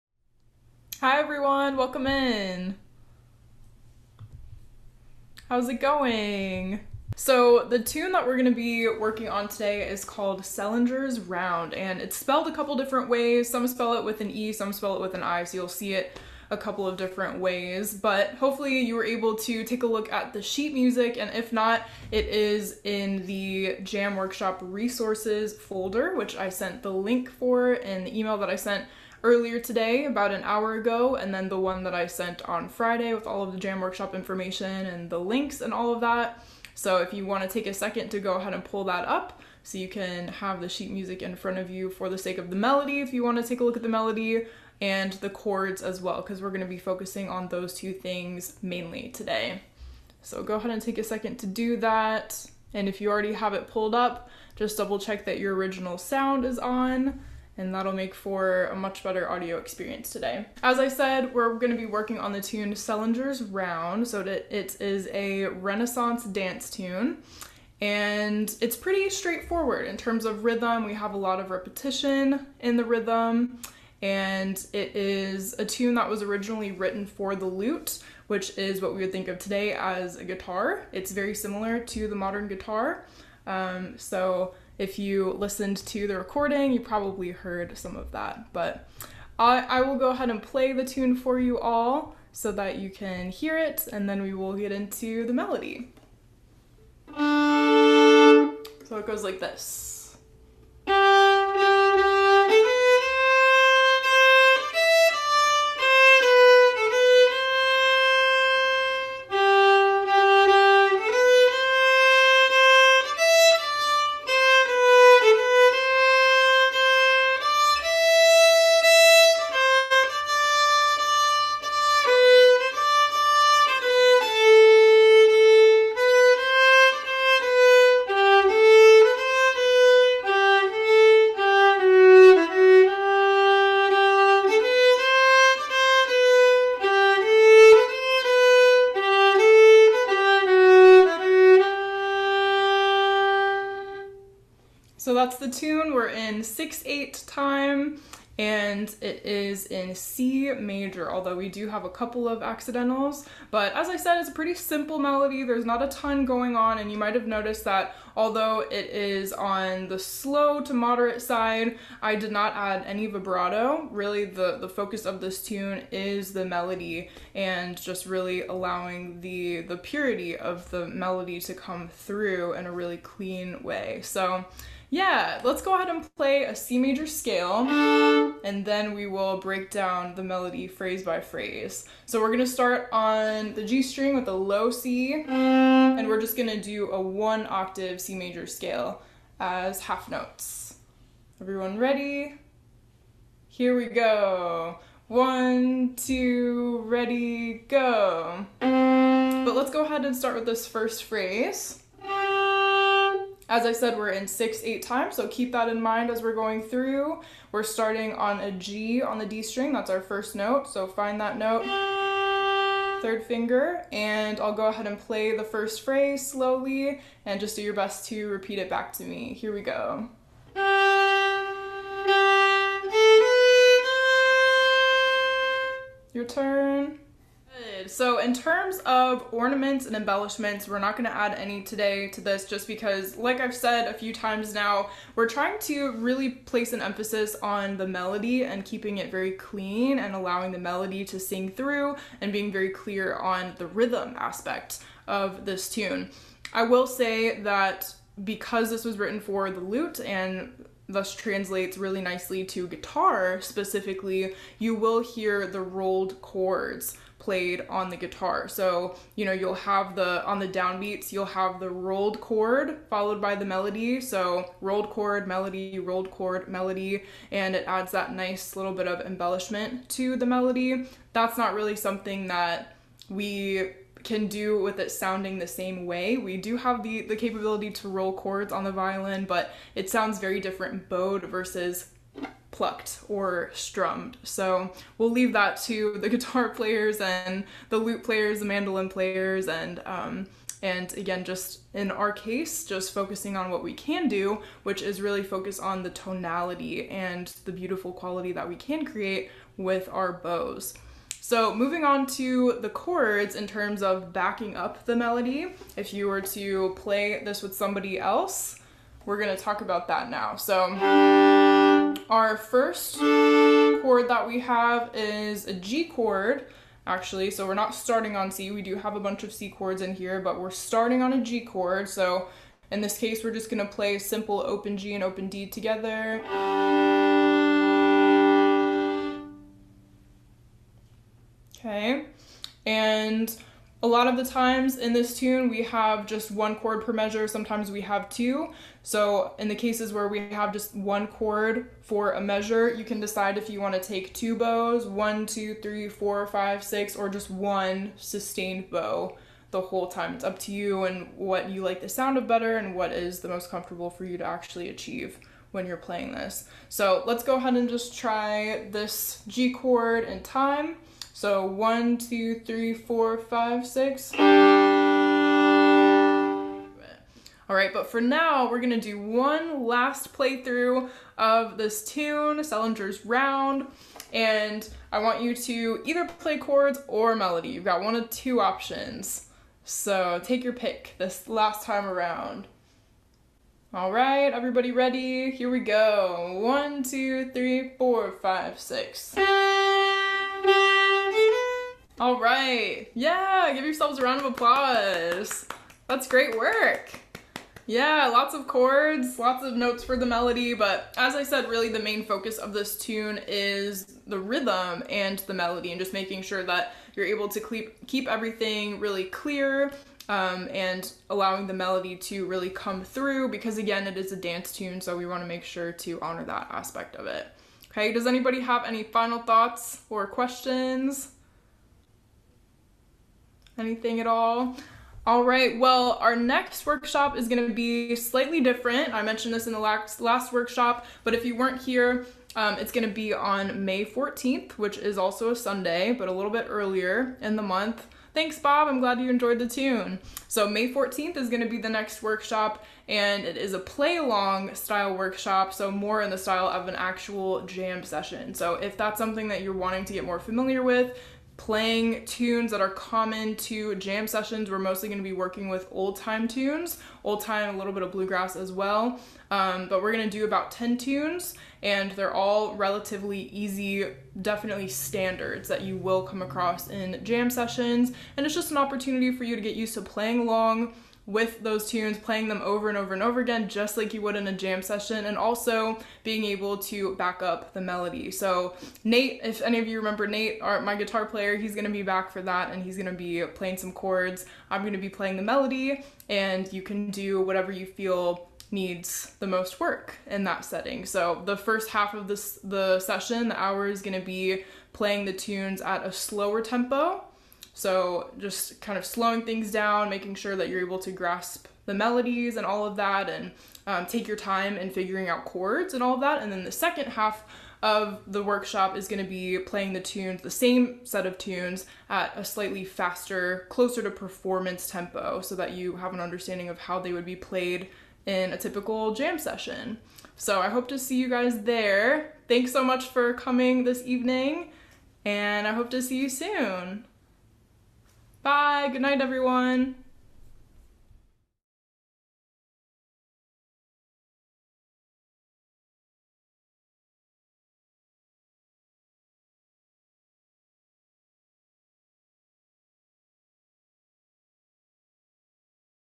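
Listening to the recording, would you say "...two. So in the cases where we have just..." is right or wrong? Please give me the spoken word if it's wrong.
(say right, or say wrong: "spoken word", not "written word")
right.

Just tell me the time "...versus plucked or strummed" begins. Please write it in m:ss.
4:41.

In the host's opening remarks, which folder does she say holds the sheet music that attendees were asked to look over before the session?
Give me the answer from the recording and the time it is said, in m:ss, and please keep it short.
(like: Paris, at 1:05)
Jam Workshop resources folder, at 0:23.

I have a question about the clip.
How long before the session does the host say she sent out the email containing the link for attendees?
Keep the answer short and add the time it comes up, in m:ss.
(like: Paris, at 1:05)
About an hour ago, at 0:30.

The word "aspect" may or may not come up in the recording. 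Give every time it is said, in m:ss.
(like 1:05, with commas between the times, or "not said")
4:04, 6:56.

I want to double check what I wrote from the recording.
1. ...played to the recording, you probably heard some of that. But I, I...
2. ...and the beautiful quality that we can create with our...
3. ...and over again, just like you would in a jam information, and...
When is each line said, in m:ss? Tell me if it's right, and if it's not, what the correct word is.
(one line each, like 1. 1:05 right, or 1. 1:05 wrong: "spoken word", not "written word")
1. 1:25 wrong: "listened", not "played"
2. 4:56 right
3. 7:52 wrong: "session", not "information".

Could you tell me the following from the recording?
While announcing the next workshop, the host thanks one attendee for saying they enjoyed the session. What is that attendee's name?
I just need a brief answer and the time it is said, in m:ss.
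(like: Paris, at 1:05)
Bob, at 7:18.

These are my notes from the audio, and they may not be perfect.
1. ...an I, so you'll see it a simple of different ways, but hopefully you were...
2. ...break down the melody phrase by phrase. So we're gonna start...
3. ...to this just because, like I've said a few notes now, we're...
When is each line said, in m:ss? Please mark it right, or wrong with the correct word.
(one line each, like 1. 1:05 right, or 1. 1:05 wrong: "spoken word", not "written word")
1. 0:15 wrong: "couple", not "simple"
2. 2:59 right
3. 3:52 wrong: "times", not "notes".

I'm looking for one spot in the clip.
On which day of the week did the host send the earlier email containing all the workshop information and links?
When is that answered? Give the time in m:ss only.
0:32.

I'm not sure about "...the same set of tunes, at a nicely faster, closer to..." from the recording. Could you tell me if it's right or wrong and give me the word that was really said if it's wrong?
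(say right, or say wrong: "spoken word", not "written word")
wrong: "slightly", not "nicely".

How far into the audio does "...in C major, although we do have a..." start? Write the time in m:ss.
2:29.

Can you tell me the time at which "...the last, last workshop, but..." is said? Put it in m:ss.
7:09.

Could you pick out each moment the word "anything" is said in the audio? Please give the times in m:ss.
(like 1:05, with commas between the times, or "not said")
7:03.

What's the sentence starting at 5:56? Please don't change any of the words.
So let's go ahead and just try this G chord in time.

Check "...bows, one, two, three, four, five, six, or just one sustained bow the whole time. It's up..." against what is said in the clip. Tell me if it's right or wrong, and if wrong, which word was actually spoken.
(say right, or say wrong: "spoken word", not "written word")
right.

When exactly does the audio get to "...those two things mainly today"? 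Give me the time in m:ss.
0:47.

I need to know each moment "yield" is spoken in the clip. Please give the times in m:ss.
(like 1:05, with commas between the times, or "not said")
not said.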